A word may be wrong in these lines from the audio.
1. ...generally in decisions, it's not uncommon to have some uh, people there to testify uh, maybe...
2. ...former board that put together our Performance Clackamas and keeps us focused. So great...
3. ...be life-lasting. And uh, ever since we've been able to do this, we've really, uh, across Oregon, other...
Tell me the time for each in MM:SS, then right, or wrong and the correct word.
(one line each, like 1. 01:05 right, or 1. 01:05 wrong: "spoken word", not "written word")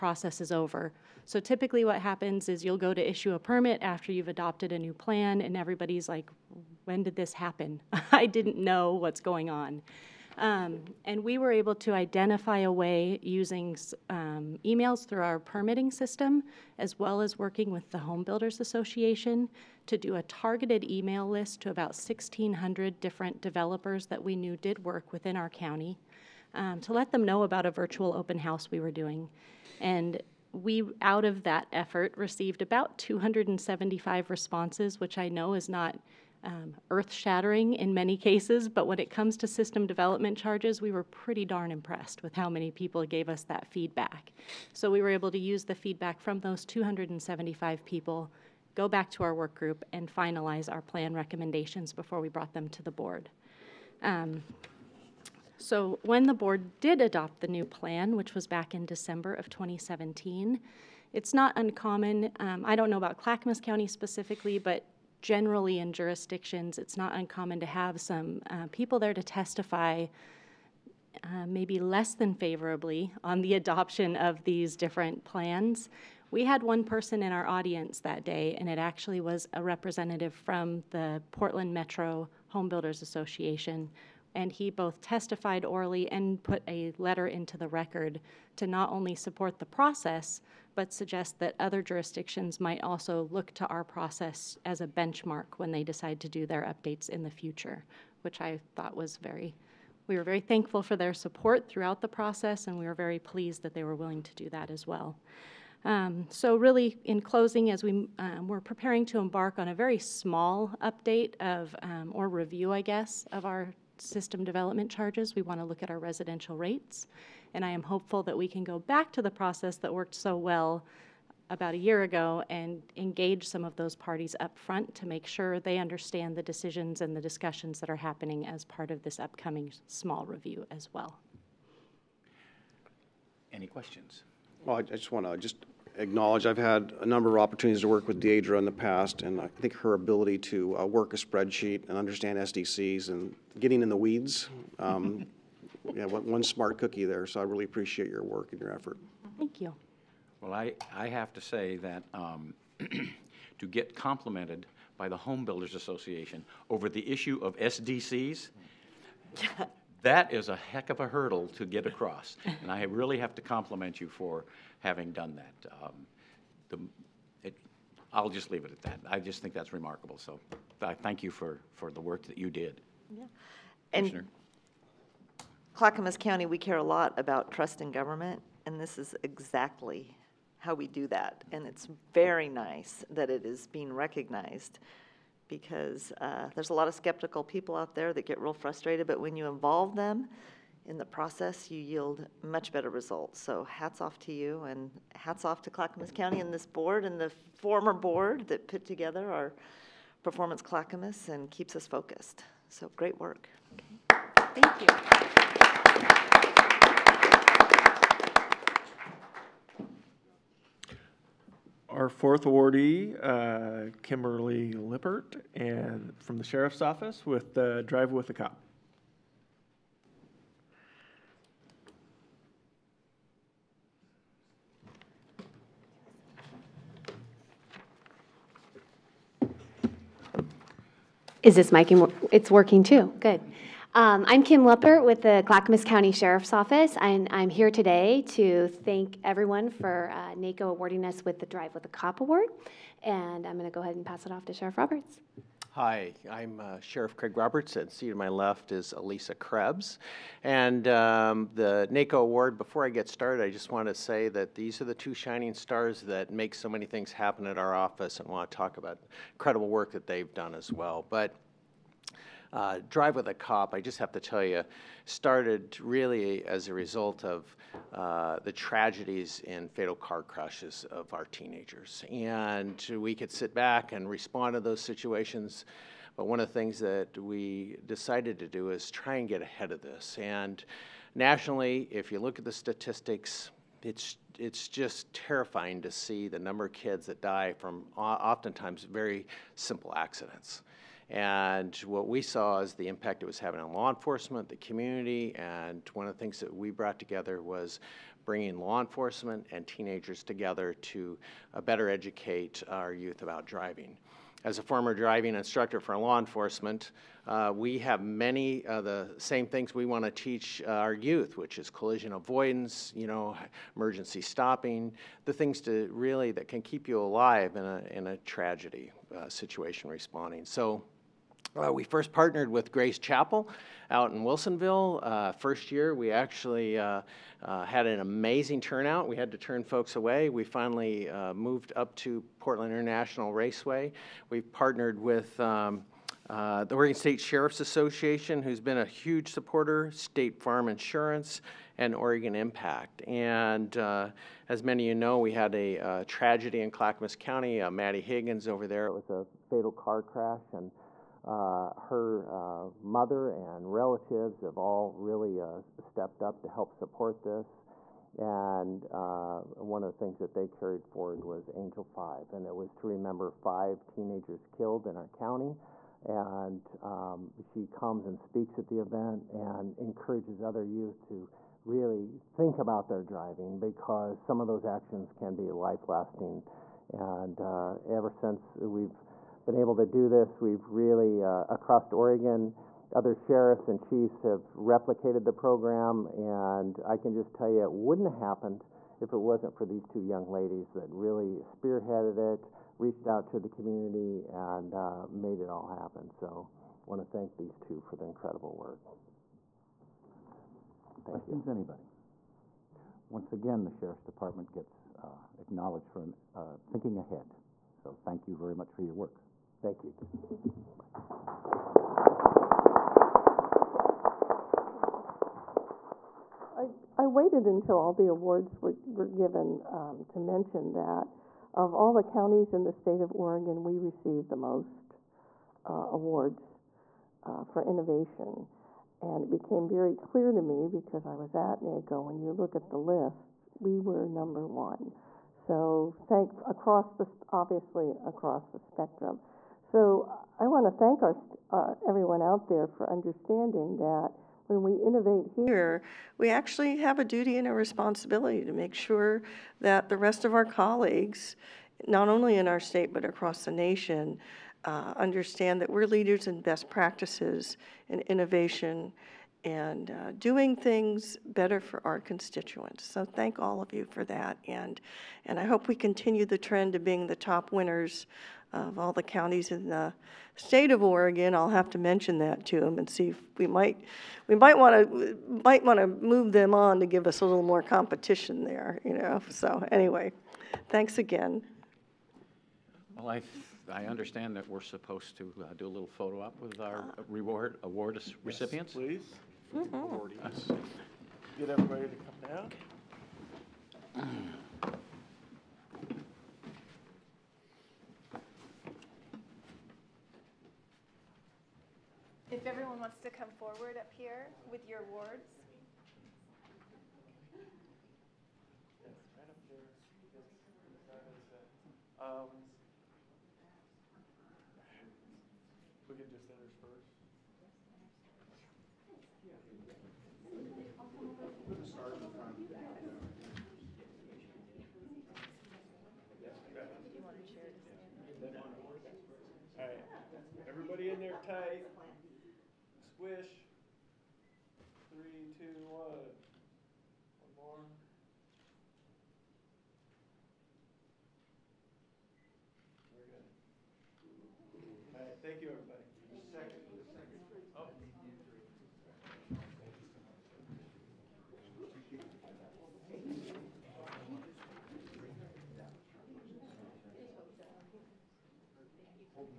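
1. 01:05 wrong: "jurisdictions", not "decisions"
2. 03:17 right
3. 06:15 right.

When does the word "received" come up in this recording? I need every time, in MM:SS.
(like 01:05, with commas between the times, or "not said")
00:32, 07:03.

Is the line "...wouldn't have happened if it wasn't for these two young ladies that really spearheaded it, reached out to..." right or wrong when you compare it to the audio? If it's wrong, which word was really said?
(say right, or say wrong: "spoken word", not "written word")
right.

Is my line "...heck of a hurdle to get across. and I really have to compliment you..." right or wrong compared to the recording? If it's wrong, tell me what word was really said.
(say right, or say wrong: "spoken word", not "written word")
right.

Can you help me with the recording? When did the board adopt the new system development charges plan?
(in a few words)
December 2017.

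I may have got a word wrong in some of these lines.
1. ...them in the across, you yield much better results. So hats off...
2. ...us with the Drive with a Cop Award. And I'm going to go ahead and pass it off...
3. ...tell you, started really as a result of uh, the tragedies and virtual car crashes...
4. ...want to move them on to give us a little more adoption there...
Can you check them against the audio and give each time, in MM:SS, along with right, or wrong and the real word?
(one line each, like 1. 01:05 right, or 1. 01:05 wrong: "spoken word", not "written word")
1. 03:09 wrong: "process", not "across"
2. 04:01 right
3. 04:24 wrong: "fatal", not "virtual"
4. 07:55 wrong: "competition", not "adoption".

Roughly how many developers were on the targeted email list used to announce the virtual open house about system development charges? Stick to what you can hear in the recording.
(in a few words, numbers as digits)
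1,600.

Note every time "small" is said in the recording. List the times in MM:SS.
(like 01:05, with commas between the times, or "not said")
01:49, 02:09.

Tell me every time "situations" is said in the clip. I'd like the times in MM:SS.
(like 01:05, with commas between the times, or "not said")
04:34, 05:19.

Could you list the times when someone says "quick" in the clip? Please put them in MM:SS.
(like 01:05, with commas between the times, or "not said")
not said.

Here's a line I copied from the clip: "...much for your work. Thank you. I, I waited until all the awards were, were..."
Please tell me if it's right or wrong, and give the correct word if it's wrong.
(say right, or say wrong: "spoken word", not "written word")
right.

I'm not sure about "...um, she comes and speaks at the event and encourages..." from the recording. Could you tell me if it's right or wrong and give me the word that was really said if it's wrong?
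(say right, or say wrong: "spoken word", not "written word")
right.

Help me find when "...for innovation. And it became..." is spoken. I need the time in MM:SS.
07:07.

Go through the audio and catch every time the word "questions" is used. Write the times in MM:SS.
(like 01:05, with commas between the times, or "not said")
02:13, 06:41.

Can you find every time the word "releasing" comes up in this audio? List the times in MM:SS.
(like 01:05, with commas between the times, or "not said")
not said.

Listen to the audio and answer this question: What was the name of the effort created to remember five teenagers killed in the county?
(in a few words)
Angel 5.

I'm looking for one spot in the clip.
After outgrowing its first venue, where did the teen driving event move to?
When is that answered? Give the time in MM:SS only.
05:32.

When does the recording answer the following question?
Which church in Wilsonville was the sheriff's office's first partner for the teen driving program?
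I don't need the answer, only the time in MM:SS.
05:22.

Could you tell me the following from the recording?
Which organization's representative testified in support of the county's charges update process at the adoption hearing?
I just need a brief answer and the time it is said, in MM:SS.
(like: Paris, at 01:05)
Portland Metro Home Builders Association, at 01:21.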